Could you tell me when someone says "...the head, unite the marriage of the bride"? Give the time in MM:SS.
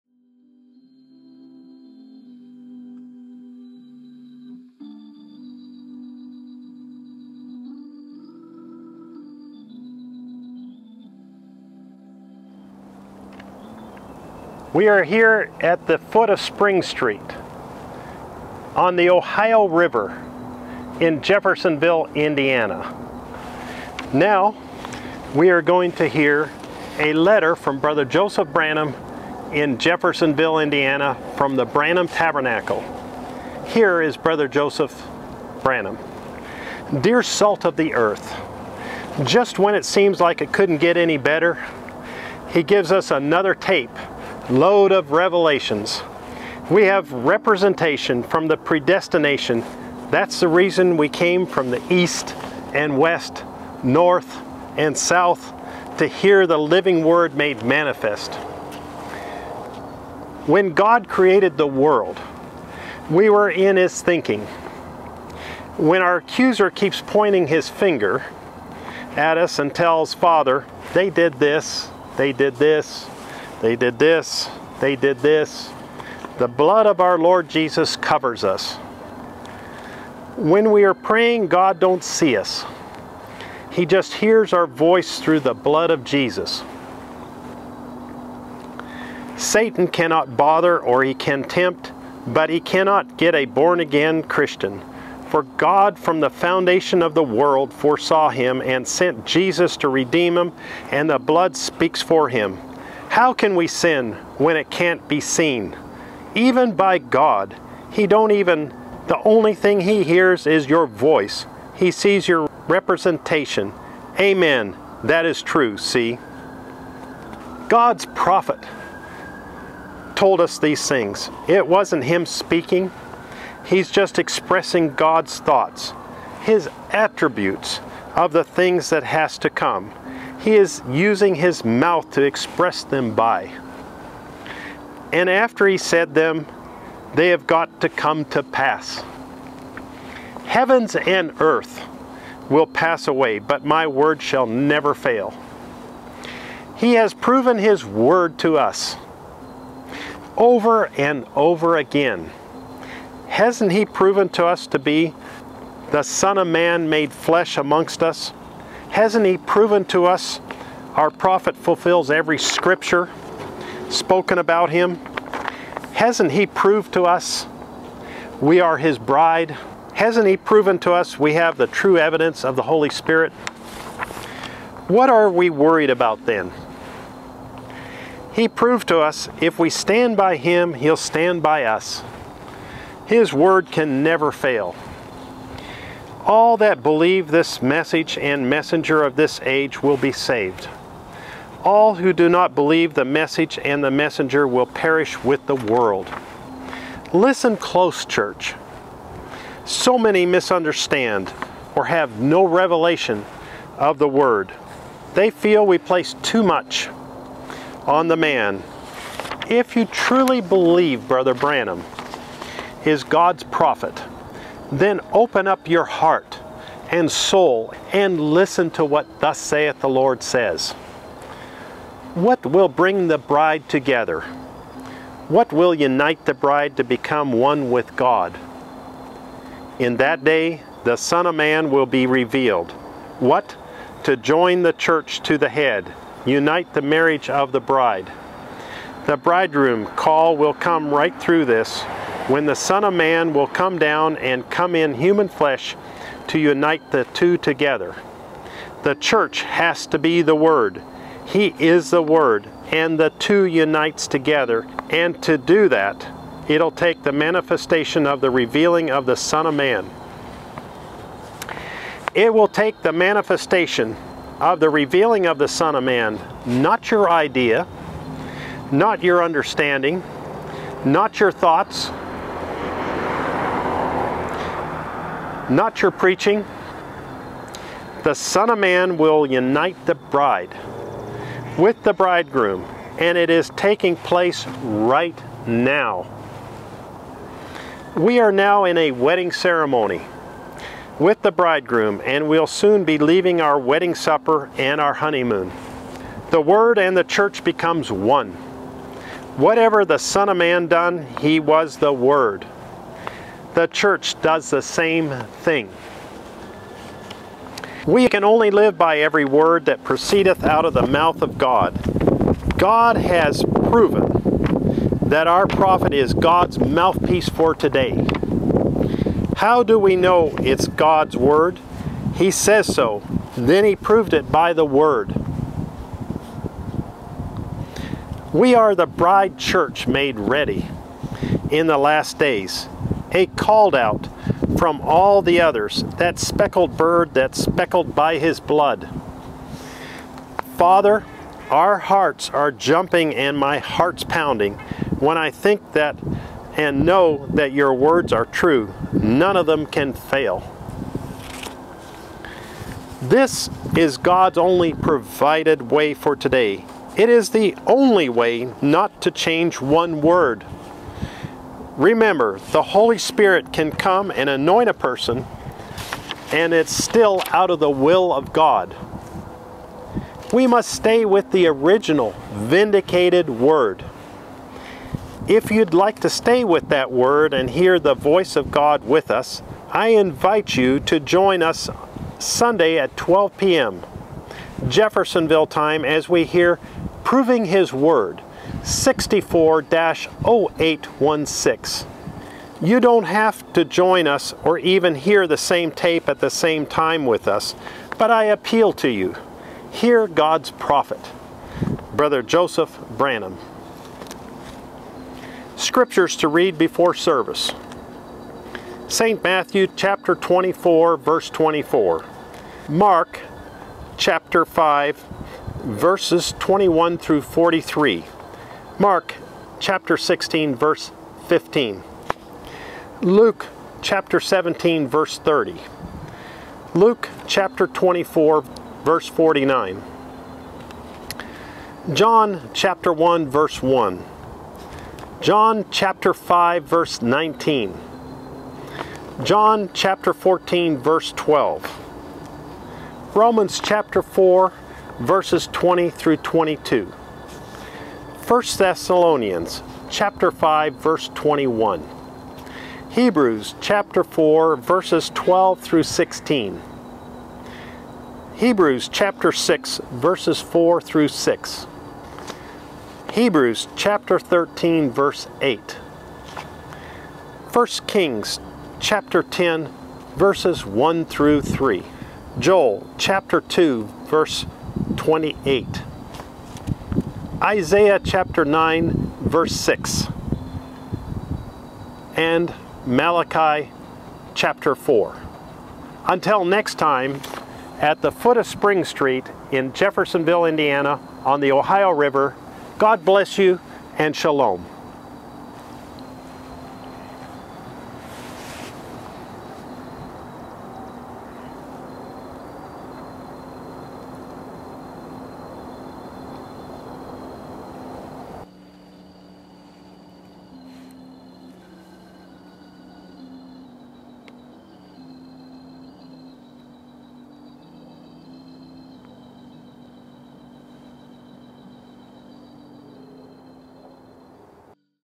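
03:55.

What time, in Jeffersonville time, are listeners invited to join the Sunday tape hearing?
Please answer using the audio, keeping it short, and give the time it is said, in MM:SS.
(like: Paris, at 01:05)
12 p.m., at 06:22.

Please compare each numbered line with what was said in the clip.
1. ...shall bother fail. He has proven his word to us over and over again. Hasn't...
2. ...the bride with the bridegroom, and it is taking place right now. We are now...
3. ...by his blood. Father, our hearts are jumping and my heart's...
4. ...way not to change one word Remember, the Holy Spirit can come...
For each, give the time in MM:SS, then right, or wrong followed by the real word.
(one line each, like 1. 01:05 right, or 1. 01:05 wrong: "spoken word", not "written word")
1. 02:24 wrong: "never", not "bother"
2. 04:39 right
3. 05:37 right
4. 05:58 right.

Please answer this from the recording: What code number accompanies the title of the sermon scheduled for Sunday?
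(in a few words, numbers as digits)
64-0816.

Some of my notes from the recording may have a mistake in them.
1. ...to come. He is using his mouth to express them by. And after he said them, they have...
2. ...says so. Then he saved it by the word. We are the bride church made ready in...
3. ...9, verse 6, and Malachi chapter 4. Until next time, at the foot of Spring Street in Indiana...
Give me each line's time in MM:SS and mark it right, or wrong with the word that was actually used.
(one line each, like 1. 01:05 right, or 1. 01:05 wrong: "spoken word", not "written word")
1. 02:09 right
2. 05:22 wrong: "proved", not "saved"
3. 07:58 wrong: "Jeffersonville", not "Indiana".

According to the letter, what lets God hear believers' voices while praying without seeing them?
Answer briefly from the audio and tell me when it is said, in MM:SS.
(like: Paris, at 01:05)
the blood of Jesus, at 01:25.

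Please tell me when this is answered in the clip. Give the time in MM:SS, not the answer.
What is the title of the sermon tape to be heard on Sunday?
06:27.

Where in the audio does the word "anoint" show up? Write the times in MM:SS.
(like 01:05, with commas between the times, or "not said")
06:04.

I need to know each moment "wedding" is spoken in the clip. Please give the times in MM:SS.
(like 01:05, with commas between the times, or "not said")
04:48, 04:53.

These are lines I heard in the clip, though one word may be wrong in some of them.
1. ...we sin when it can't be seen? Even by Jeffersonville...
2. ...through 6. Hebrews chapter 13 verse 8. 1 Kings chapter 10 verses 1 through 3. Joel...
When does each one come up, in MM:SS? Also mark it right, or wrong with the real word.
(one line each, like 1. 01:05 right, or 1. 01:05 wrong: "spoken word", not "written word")
1. 01:43 wrong: "God", not "Jeffersonville"
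2. 07:40 right.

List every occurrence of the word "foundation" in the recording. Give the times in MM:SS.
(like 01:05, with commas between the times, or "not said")
01:36.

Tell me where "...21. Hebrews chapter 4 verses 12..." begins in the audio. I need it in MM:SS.
07:31.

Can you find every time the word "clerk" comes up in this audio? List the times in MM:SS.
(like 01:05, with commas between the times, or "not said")
not said.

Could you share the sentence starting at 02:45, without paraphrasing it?
Hasn't he proved to us we are his bride?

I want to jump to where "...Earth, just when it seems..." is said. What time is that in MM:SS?
00:37.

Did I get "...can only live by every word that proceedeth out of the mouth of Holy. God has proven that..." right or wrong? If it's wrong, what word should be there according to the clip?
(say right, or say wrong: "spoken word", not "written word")
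wrong: "God", not "Holy".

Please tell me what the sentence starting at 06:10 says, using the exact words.
We must stay with the original, vindicated word.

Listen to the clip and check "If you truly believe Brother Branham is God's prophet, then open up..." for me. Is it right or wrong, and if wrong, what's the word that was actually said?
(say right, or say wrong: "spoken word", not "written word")
right.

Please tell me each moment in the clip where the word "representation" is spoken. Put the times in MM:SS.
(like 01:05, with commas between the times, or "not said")
00:47, 01:52.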